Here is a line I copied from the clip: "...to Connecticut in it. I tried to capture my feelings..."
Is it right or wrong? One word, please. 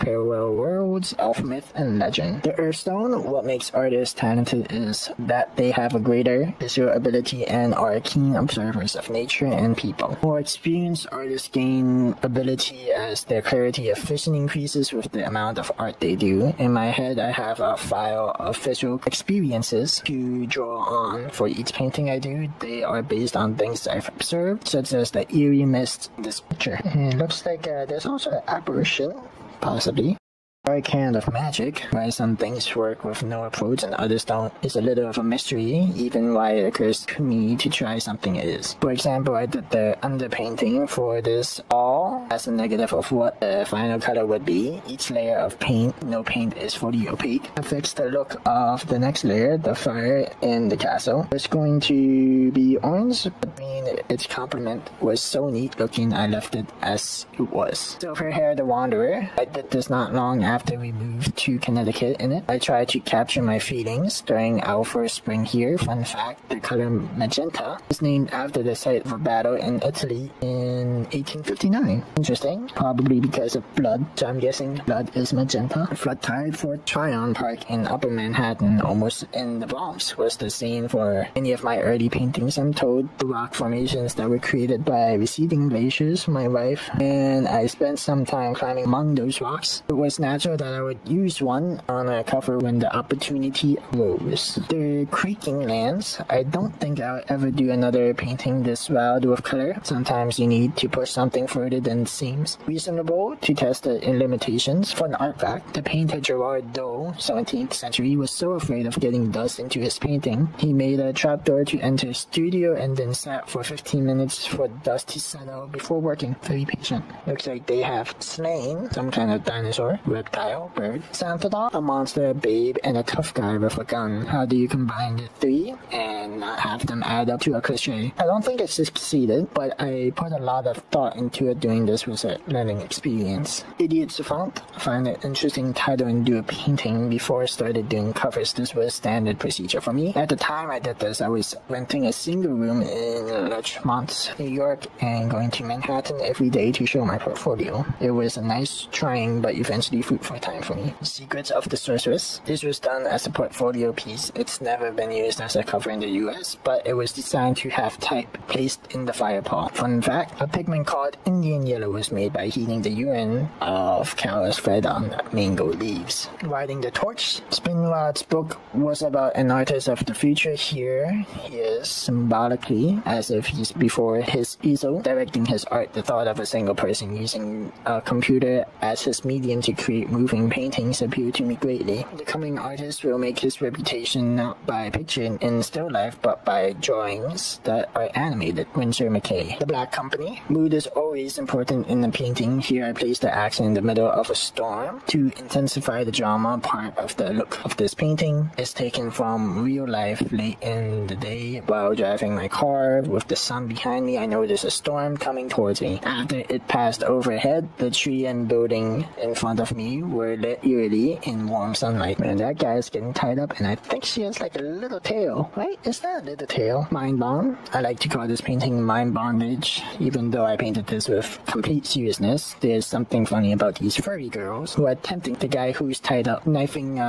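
right.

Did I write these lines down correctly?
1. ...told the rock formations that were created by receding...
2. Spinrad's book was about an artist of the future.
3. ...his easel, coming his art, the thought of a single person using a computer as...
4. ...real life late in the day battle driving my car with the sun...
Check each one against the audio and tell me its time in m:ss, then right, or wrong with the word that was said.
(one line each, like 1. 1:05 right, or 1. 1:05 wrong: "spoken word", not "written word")
1. 1:22 right
2. 2:47 right
3. 2:54 wrong: "directing", not "coming"
4. 3:19 wrong: "while", not "battle".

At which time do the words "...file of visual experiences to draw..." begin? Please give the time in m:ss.
0:17.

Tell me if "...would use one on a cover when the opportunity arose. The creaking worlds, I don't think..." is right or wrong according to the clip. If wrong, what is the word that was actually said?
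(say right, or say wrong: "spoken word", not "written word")
wrong: "lands", not "worlds".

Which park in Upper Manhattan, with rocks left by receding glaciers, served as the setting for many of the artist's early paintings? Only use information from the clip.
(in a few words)
Fort Tryon Park.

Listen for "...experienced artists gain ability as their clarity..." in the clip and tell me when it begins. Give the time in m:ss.
0:10.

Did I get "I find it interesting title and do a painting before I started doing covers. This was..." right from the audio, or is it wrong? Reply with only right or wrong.
right.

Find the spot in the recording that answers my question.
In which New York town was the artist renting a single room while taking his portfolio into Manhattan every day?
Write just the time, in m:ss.
2:23.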